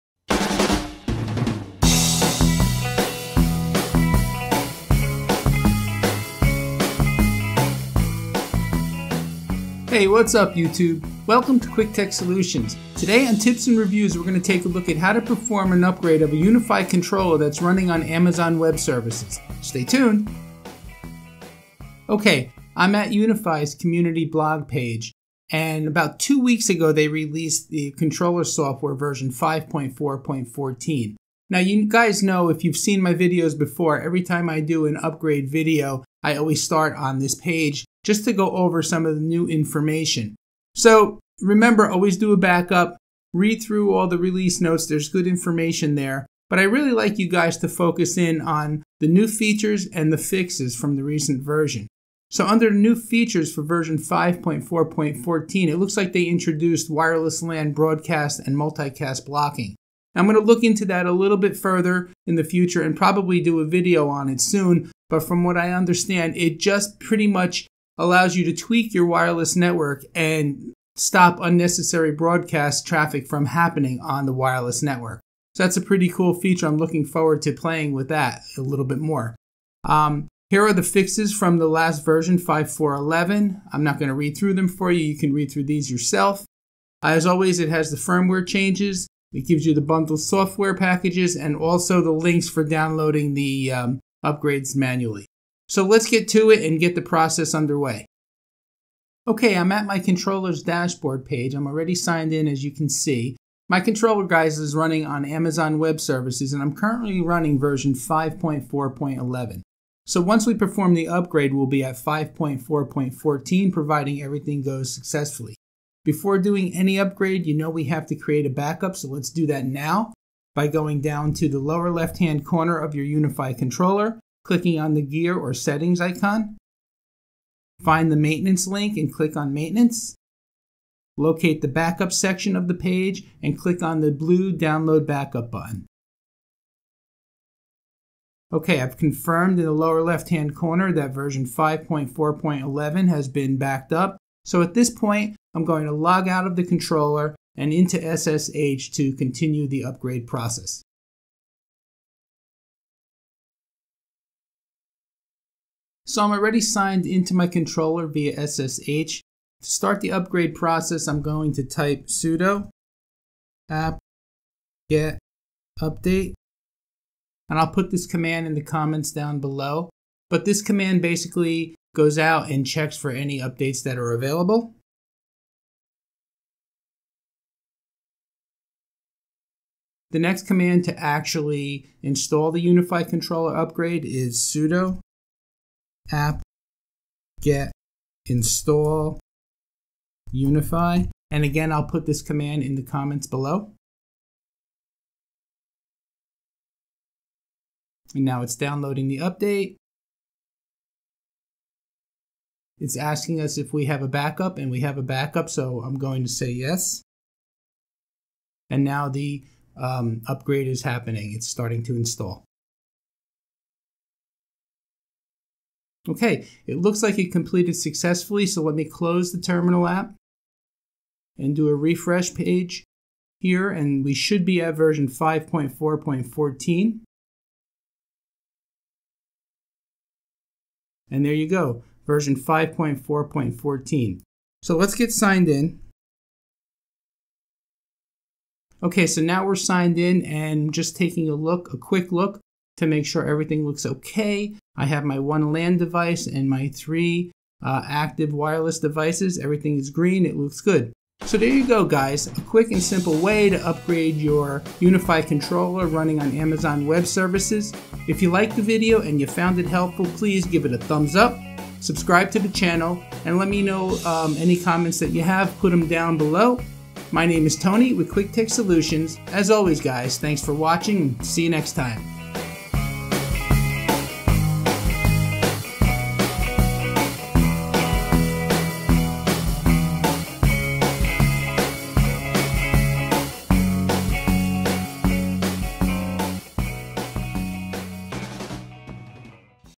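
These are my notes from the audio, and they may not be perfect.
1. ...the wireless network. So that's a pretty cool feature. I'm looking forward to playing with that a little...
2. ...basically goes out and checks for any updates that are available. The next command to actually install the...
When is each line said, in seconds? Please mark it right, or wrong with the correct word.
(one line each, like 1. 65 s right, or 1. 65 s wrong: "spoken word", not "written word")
1. 74 s right
2. 171 s right.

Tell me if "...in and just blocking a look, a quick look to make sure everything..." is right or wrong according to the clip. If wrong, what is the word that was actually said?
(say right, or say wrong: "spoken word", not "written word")
wrong: "taking", not "blocking".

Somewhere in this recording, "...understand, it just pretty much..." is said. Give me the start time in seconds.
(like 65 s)
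65 s.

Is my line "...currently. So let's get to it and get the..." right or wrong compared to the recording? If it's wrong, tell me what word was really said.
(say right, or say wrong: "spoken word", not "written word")
wrong: "manually", not "currently".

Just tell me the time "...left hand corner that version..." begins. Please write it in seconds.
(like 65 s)
140 s.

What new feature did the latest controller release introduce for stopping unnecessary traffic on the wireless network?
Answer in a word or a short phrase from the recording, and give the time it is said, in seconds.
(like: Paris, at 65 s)
Wireless LAN broadcast and multicast blocking, at 56 s.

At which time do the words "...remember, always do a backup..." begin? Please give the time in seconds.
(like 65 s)
41 s.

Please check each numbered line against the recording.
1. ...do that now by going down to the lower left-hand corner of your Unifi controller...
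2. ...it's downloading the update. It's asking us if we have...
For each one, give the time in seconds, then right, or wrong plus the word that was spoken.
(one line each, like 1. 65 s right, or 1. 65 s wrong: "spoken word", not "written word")
1. 119 s right
2. 198 s right.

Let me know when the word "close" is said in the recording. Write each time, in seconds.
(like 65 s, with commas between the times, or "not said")
218 s.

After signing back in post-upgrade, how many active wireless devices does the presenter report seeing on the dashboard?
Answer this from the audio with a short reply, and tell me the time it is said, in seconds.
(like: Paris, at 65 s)
3, at 246 s.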